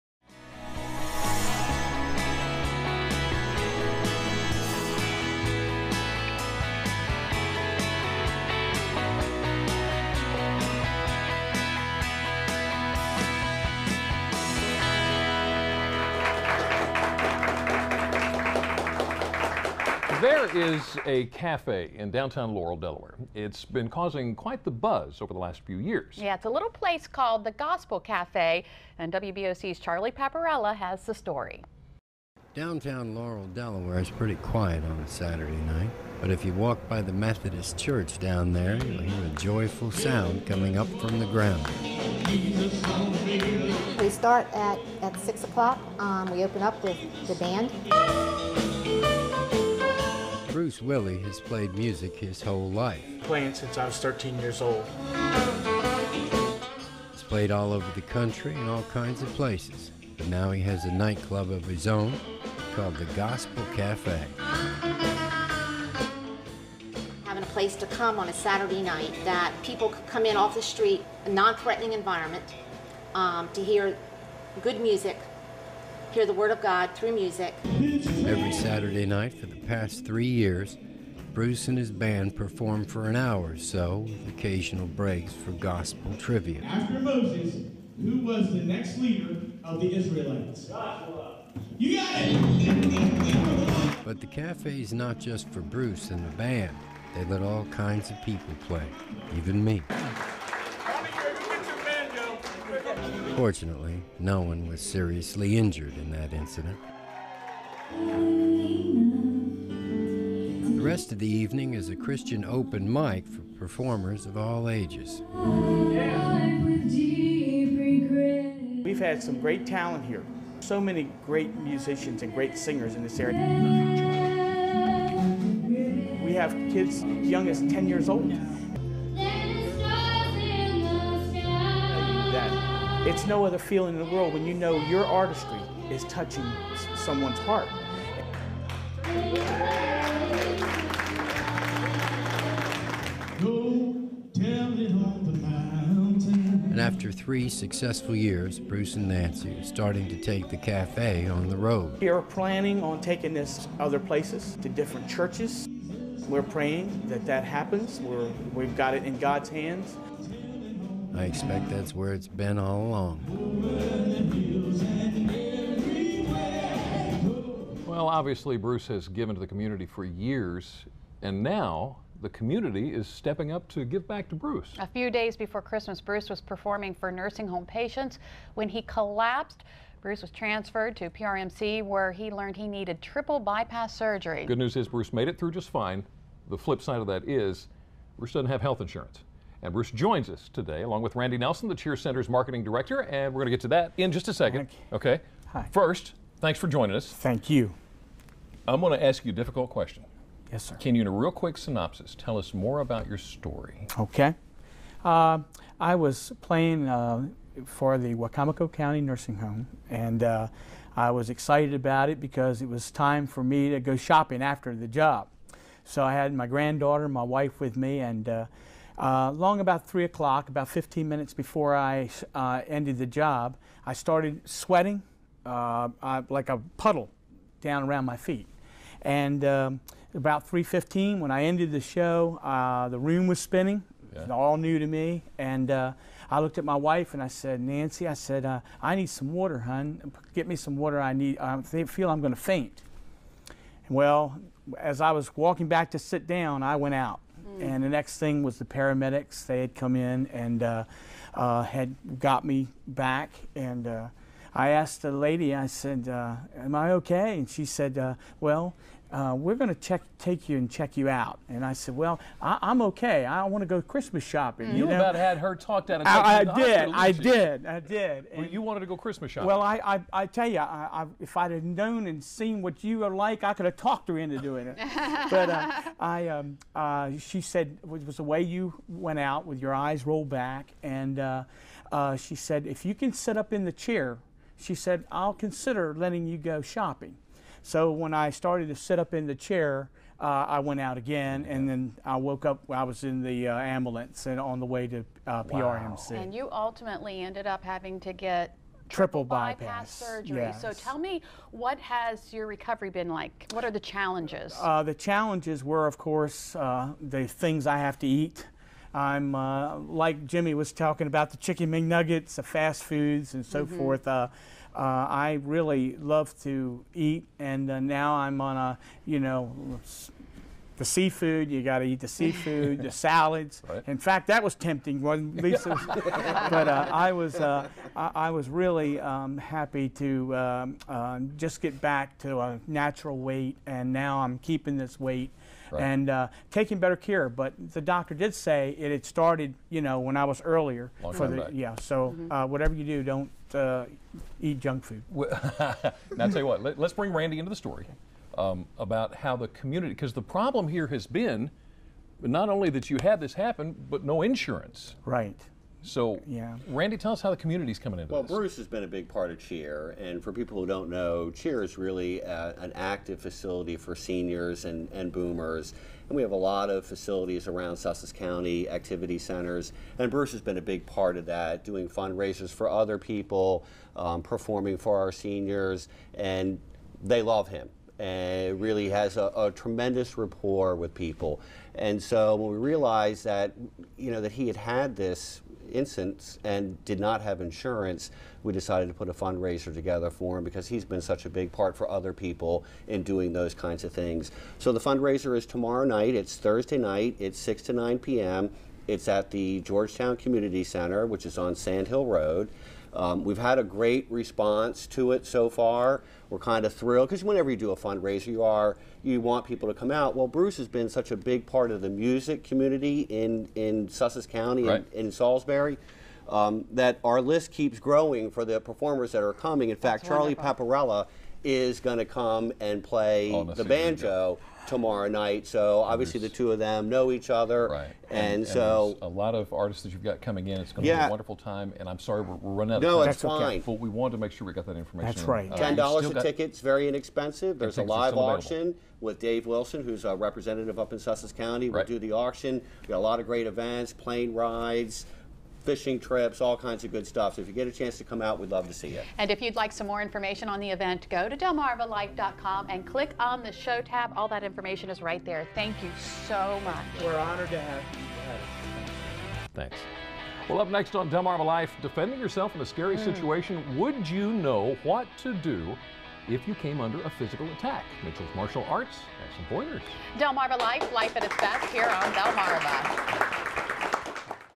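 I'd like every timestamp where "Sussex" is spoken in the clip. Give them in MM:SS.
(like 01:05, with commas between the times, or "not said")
06:07, 06:53, 07:20.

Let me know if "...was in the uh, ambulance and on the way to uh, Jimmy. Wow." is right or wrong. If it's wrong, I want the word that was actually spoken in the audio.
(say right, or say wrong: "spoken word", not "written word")
wrong: "PRMC", not "Jimmy".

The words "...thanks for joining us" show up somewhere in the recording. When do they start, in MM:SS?
03:16.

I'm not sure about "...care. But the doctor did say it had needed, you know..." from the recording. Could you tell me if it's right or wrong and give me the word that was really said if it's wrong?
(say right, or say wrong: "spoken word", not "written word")
wrong: "started", not "needed".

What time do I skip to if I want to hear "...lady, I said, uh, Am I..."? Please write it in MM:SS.
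04:15.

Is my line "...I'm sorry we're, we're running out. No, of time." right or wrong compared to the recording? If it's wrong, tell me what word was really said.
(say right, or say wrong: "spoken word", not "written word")
right.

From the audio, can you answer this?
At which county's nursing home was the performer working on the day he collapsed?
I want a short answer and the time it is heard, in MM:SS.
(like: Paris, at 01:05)
Wicomico County, at 03:28.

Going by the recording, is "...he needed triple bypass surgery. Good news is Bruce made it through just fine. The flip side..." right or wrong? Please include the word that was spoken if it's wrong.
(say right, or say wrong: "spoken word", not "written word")
right.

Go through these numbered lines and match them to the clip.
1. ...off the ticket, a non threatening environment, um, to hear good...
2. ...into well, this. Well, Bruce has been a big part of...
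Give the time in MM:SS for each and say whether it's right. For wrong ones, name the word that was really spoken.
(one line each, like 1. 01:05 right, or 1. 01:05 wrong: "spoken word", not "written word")
1. 01:10 wrong: "street", not "ticket"
2. 05:57 right.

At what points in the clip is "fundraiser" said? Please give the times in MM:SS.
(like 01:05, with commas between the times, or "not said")
06:11, 06:29, 06:34, 06:47.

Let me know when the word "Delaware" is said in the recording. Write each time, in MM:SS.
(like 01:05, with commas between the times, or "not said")
00:22, 00:33.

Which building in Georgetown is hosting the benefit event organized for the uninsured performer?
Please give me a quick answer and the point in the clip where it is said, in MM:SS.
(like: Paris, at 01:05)
Georgetown Community Center, at 06:39.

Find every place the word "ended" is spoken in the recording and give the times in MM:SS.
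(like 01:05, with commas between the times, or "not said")
03:42, 03:51, 04:57.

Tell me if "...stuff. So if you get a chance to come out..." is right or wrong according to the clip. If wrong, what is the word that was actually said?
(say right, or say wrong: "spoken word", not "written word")
right.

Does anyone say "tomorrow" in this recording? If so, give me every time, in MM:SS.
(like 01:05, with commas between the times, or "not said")
06:35, 07:04.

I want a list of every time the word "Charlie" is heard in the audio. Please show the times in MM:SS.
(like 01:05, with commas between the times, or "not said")
00:29, 07:00.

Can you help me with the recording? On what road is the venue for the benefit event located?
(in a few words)
Sand Hill Road.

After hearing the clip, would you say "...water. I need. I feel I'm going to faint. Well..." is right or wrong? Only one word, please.
right.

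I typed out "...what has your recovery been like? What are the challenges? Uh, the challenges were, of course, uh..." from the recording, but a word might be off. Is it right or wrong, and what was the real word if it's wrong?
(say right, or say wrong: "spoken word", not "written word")
right.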